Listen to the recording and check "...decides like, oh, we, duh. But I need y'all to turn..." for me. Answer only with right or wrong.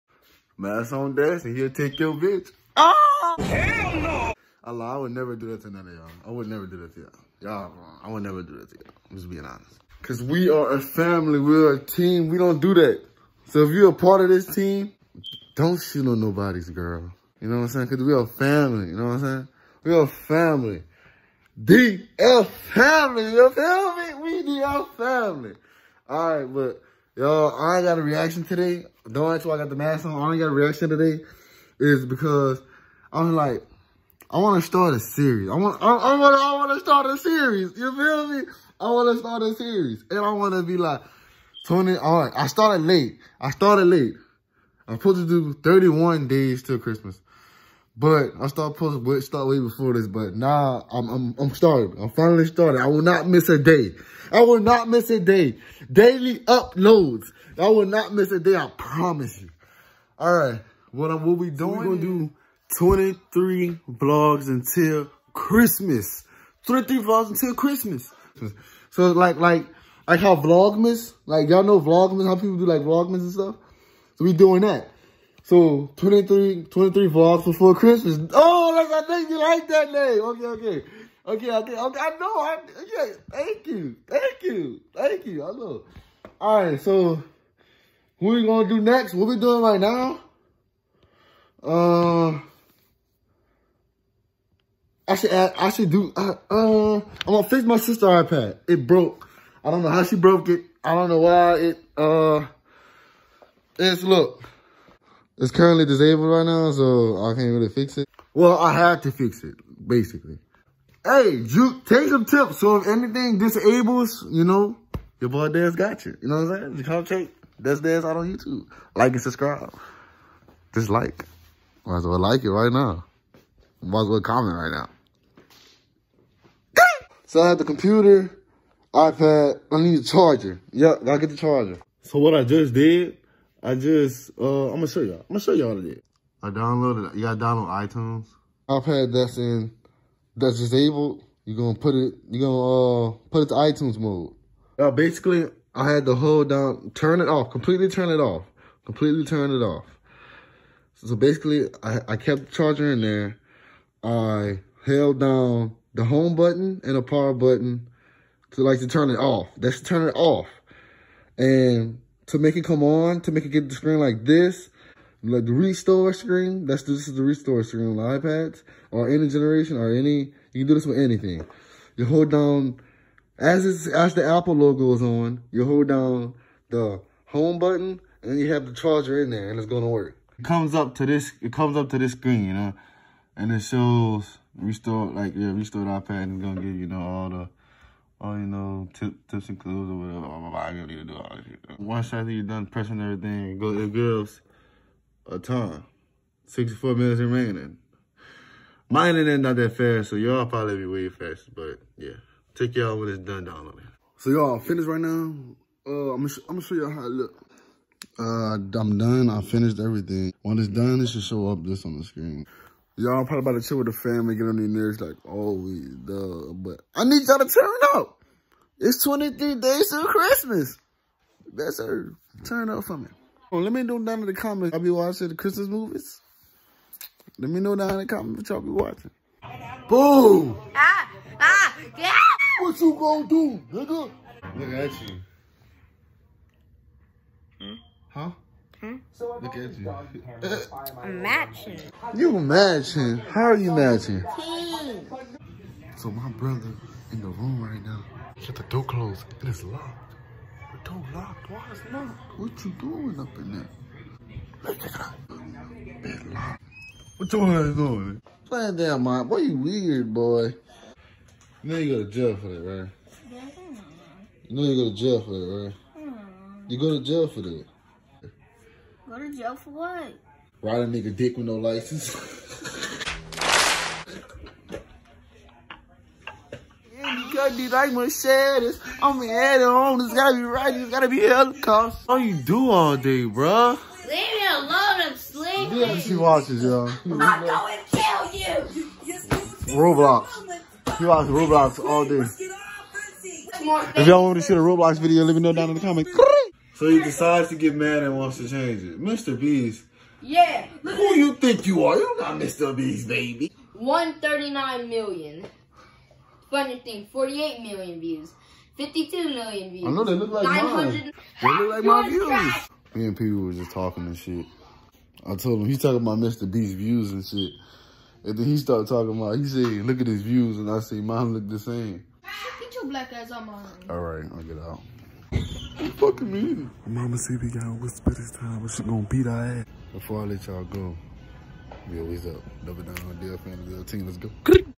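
wrong.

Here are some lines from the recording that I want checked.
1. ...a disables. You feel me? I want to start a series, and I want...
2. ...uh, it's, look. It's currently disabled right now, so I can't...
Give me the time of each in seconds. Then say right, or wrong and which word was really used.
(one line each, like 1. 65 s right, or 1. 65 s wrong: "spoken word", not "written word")
1. 37 s wrong: "series", not "disables"
2. 101 s right.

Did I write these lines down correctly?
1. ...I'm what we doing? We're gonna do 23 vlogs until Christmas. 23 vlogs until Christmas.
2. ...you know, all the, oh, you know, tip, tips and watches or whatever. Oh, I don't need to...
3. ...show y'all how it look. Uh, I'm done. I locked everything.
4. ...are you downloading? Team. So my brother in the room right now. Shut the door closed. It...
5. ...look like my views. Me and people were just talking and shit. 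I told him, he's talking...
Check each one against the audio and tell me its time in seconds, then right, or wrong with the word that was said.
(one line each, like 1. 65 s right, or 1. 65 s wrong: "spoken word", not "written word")
1. 61 s right
2. 186 s wrong: "clues", not "watches"
3. 206 s wrong: "finished", not "locked"
4. 243 s wrong: "matching", not "downloading"
5. 311 s right.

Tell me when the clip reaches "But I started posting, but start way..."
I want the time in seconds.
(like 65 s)
47 s.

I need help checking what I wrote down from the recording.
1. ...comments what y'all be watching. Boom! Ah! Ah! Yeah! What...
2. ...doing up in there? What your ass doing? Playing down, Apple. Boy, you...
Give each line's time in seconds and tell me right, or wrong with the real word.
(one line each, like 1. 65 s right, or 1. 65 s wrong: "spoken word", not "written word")
1. 228 s right
2. 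252 s wrong: "Mom", not "Apple".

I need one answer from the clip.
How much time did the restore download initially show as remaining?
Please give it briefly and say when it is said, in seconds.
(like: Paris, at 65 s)
64 minutes, at 196 s.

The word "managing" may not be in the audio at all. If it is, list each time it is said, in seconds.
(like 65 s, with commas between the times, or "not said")
not said.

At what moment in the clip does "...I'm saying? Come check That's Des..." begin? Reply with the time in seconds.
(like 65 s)
116 s.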